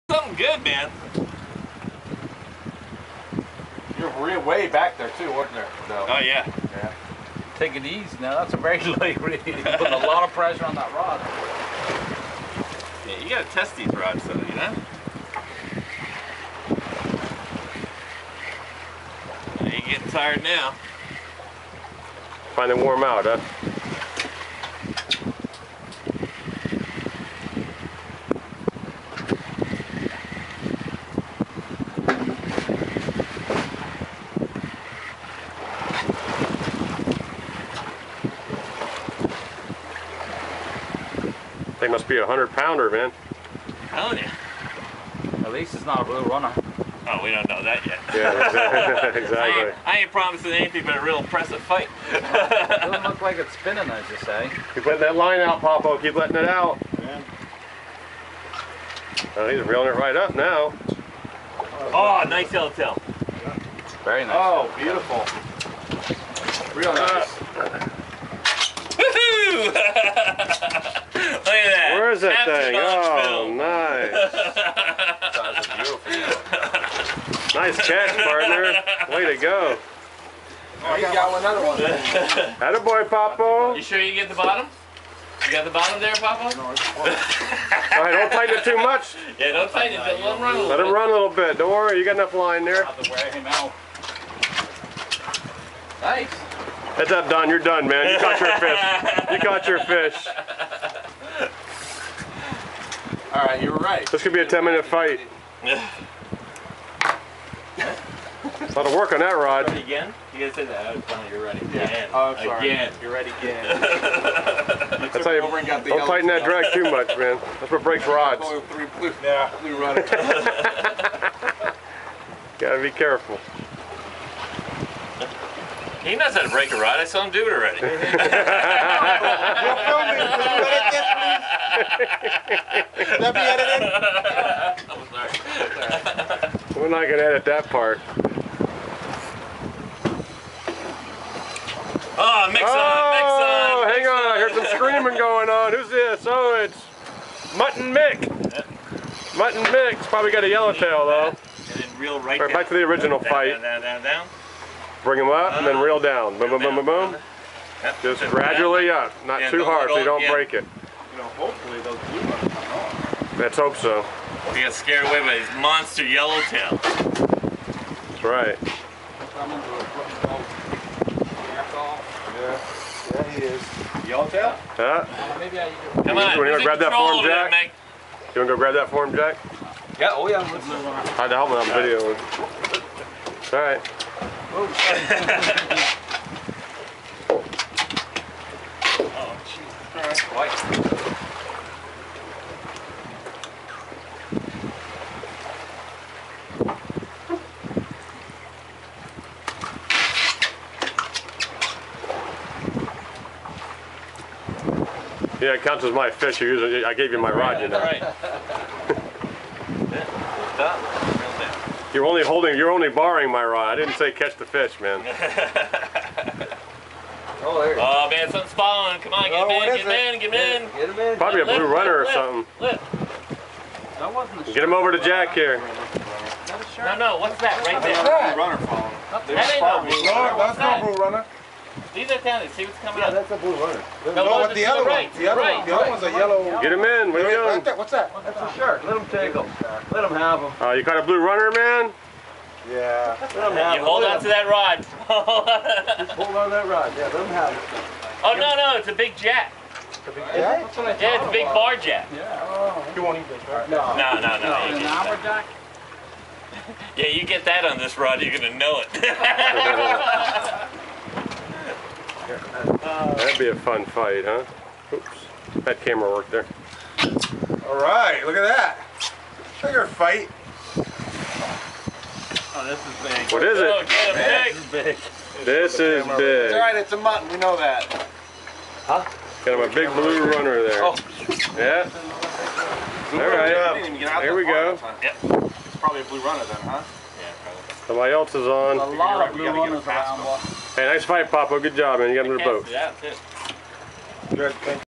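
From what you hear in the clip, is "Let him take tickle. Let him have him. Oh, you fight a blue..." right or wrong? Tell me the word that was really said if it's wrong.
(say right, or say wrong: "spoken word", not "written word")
wrong: "caught", not "fight".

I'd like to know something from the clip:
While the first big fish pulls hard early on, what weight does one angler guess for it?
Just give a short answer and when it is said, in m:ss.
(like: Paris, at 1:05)
100 pounds, at 0:42.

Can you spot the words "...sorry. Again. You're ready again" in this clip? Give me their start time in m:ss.
1:52.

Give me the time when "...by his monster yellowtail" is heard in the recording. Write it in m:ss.
2:45.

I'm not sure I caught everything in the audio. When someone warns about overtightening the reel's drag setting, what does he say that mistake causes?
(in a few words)
breaks rods.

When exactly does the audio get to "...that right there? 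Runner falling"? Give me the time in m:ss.
3:47.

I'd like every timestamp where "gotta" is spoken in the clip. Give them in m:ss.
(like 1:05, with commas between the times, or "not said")
0:13, 2:02.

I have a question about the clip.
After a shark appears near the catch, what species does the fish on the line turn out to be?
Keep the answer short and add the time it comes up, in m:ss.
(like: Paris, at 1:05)
bar jack, at 4:11.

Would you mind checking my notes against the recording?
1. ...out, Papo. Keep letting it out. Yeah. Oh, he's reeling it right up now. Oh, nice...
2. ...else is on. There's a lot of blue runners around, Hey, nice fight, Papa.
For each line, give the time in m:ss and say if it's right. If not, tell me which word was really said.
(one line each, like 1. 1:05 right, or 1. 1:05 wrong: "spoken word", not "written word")
1. 0:55 right
2. 4:48 right.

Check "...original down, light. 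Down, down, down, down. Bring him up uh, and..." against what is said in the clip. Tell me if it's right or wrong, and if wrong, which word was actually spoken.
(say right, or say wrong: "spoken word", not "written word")
wrong: "fight", not "light".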